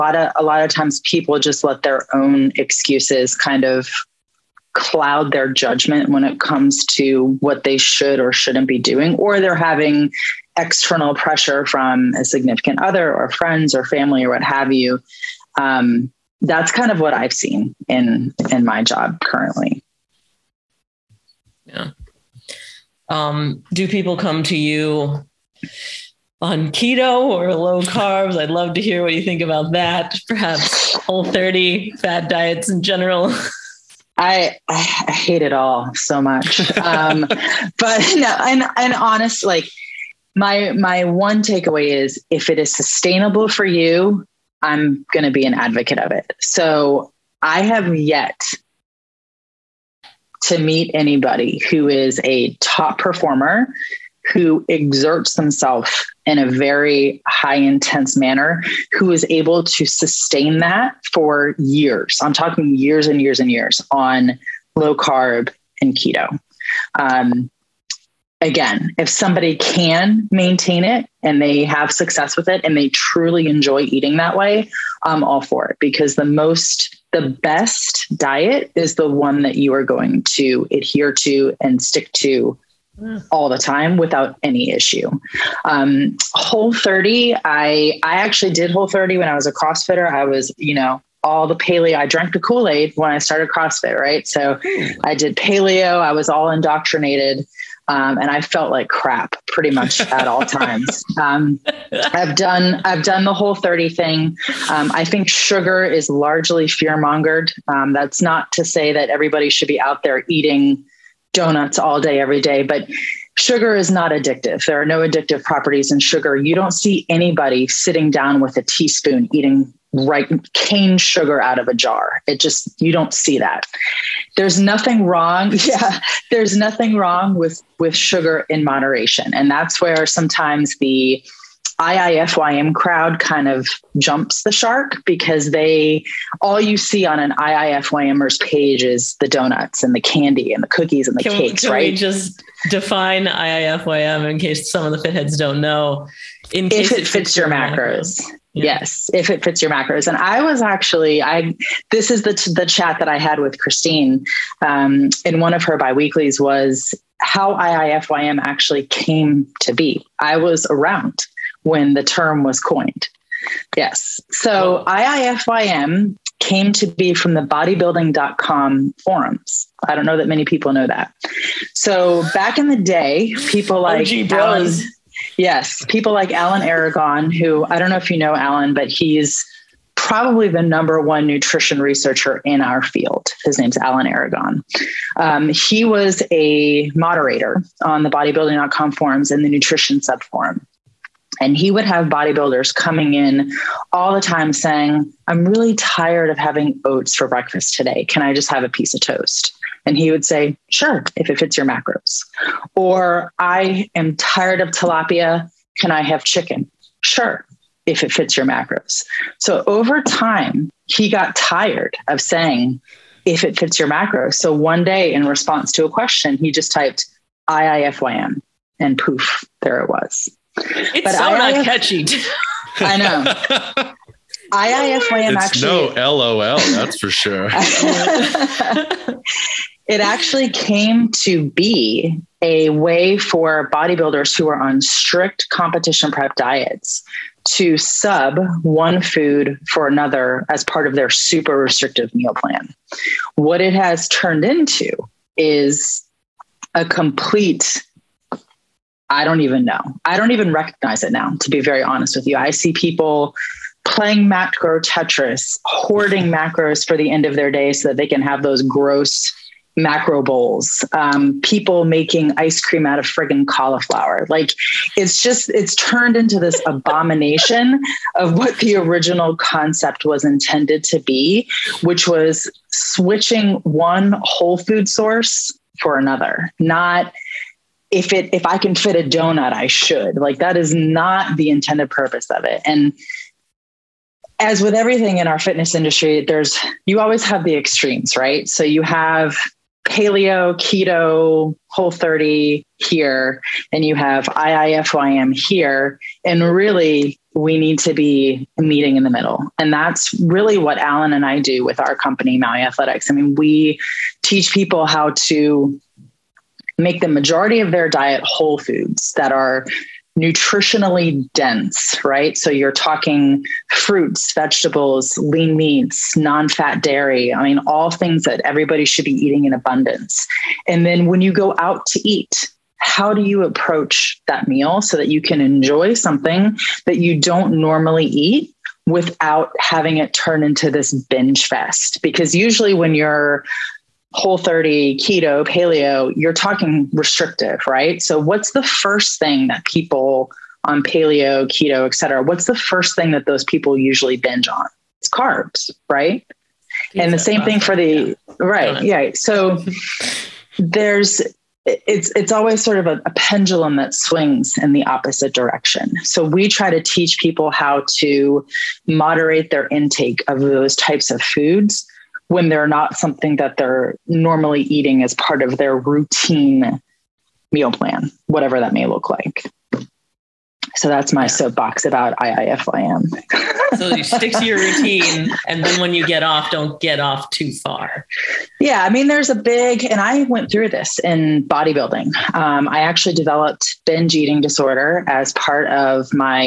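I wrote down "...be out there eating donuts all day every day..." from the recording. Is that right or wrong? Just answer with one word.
right.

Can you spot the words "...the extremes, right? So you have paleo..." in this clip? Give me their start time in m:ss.
4:47.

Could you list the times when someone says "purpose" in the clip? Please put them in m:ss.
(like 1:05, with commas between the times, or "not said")
4:41.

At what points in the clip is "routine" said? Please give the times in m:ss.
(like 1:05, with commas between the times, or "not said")
6:05, 6:14.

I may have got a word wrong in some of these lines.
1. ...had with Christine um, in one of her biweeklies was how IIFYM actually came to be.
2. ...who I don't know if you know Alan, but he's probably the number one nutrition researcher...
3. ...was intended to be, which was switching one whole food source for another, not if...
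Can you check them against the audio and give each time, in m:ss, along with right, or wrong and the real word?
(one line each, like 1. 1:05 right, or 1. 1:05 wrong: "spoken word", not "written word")
1. 2:33 right
2. 2:57 right
3. 4:30 right.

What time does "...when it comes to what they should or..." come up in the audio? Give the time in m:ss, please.
0:06.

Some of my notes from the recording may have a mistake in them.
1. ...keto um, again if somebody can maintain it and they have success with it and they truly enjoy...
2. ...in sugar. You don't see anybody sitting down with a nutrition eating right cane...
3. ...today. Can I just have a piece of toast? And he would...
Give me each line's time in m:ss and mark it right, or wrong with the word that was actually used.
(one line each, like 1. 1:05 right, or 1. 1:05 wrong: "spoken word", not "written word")
1. 1:05 right
2. 1:55 wrong: "teaspoon", not "nutrition"
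3. 3:17 right.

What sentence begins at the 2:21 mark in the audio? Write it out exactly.
We just define IIFYM in case some of the fitheads don't know.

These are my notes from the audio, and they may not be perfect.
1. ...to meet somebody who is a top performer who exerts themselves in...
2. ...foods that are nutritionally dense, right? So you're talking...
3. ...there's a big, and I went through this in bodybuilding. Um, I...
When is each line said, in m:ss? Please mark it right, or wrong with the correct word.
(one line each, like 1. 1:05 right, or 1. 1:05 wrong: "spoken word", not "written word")
1. 0:50 wrong: "anybody", not "somebody"
2. 5:08 right
3. 6:19 right.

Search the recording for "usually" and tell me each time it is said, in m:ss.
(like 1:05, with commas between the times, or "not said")
5:32, 5:43.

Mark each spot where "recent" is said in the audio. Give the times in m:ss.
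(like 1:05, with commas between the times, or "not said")
not said.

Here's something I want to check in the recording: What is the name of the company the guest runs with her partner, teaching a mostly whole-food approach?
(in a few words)
Maui Athletics.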